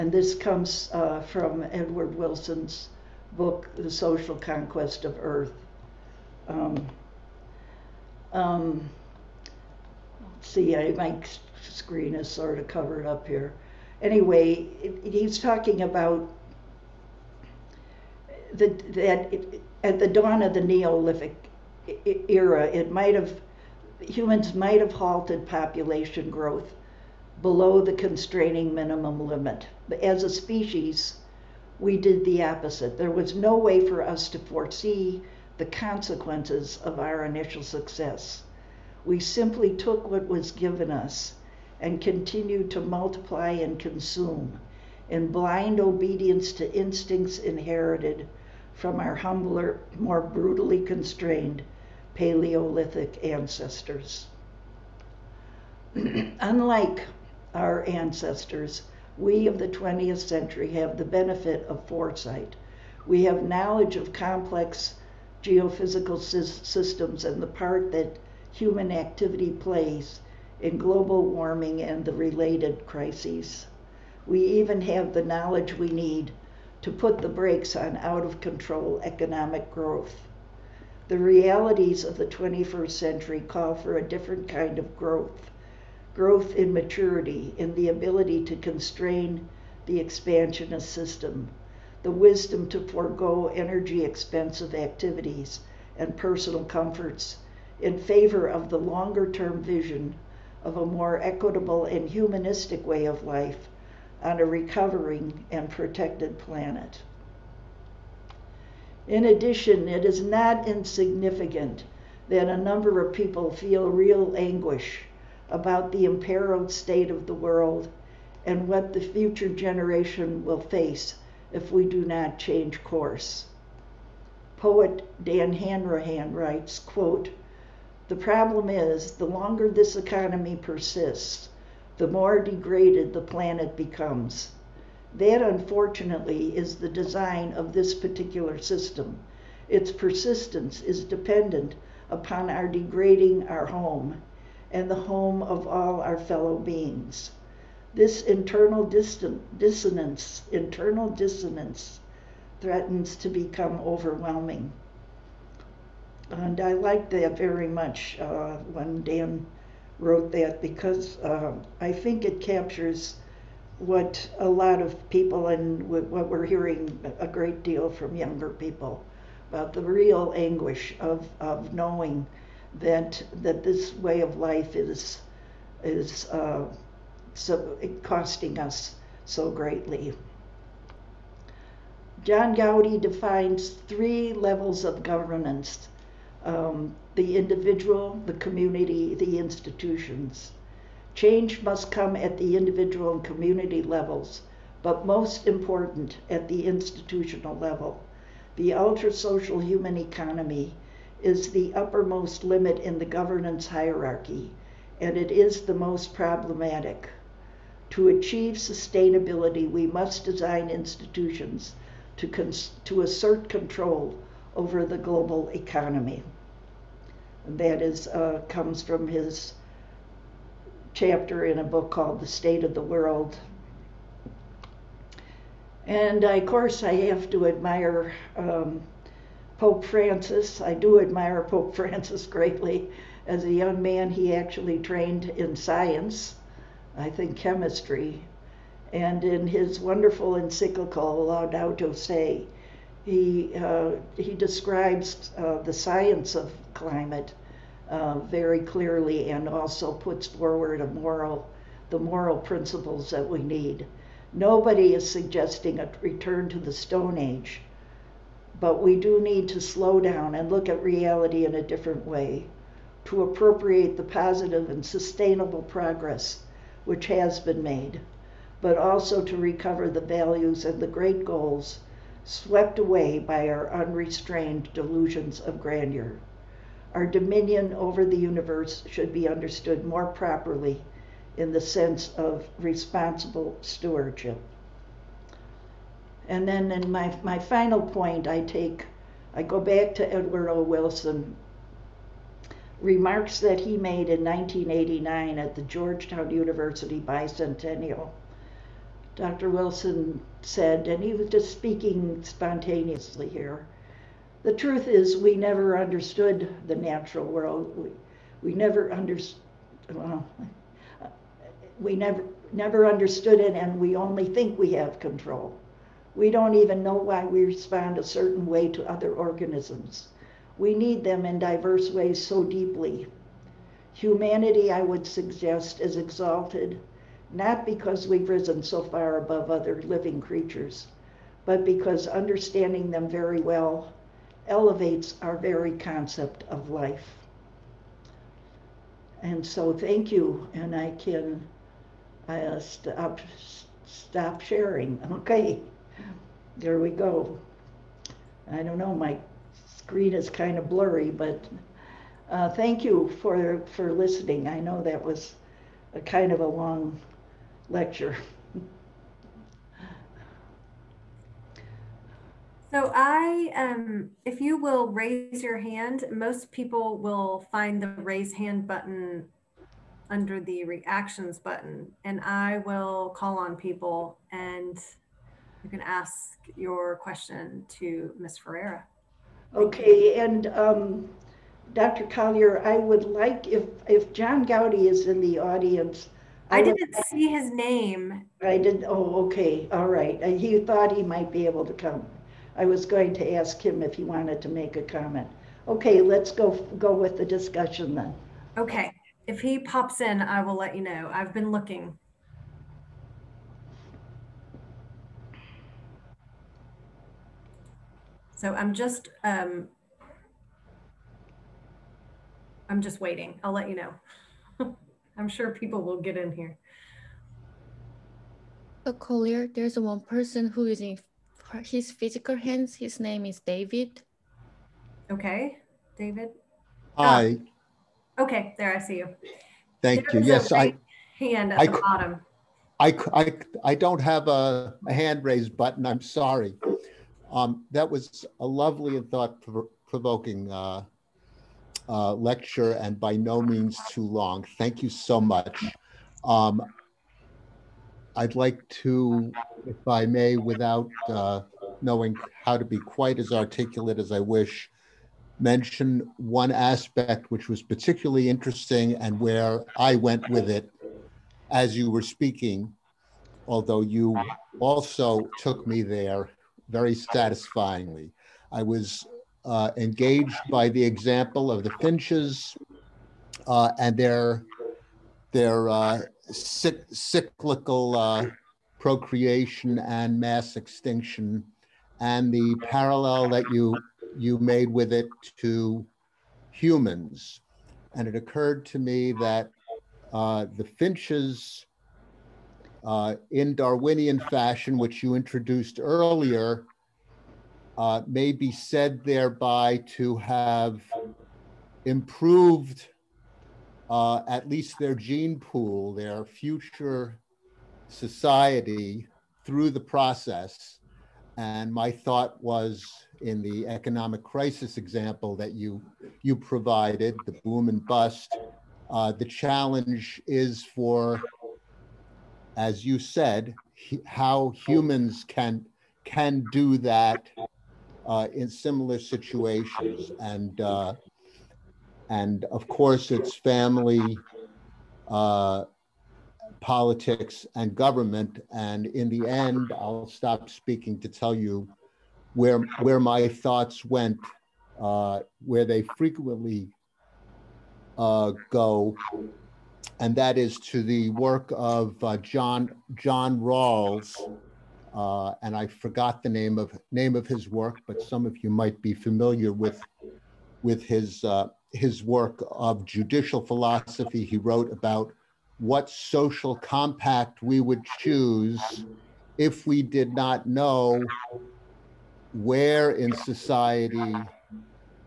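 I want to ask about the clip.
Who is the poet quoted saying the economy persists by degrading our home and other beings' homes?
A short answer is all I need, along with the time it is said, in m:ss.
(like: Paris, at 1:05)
Dan Hanrahan, at 2:05.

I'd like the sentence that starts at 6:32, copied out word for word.
I was going to ask him if he wanted to make a comment.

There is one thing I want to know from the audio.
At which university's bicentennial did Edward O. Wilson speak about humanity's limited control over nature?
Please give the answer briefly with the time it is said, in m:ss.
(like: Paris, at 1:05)
Georgetown University, at 4:55.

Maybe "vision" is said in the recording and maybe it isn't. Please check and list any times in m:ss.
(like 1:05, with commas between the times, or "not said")
1:39.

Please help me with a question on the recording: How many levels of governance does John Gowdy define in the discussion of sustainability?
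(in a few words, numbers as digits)
3.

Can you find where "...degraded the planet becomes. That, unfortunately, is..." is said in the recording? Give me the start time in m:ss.
2:12.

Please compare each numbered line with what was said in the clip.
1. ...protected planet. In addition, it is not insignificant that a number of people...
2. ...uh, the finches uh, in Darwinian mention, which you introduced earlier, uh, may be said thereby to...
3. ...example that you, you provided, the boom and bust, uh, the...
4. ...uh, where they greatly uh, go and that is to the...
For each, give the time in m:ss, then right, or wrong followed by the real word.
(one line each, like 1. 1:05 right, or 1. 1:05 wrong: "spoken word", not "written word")
1. 1:45 right
2. 8:10 wrong: "fashion", not "mention"
3. 8:34 right
4. 9:04 wrong: "frequently", not "greatly".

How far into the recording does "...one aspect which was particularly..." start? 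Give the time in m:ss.
7:36.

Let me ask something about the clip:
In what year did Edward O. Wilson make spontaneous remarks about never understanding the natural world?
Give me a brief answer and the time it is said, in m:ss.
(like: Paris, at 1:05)
1989, at 4:54.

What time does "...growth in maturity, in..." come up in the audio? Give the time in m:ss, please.
1:26.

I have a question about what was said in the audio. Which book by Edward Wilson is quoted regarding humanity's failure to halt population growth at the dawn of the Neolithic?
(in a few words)
The Social Conquest of Earth.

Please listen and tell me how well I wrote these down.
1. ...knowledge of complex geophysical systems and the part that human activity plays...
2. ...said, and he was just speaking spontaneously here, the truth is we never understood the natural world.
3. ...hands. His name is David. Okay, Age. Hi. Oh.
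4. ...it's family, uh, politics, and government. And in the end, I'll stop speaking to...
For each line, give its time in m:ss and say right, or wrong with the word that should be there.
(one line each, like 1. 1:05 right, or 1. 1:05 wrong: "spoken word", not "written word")
1. 1:03 right
2. 5:00 right
3. 7:02 wrong: "David", not "Age"
4. 8:53 right.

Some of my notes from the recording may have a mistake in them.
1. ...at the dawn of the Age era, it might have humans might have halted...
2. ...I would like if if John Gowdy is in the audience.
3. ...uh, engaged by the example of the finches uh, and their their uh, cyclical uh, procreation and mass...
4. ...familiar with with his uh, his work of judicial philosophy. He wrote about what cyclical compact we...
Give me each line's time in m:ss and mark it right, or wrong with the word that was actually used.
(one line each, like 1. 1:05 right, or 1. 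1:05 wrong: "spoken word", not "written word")
1. 0:19 wrong: "Neolithic", not "Age"
2. 6:22 right
3. 7:49 right
4. 9:18 wrong: "social", not "cyclical".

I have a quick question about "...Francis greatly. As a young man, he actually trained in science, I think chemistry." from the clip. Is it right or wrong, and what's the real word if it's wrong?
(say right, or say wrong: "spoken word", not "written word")
right.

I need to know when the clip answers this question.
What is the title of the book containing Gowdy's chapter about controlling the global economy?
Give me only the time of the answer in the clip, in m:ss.
3:42.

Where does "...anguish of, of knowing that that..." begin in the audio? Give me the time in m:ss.
2:50.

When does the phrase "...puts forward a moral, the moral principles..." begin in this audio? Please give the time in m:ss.
4:09.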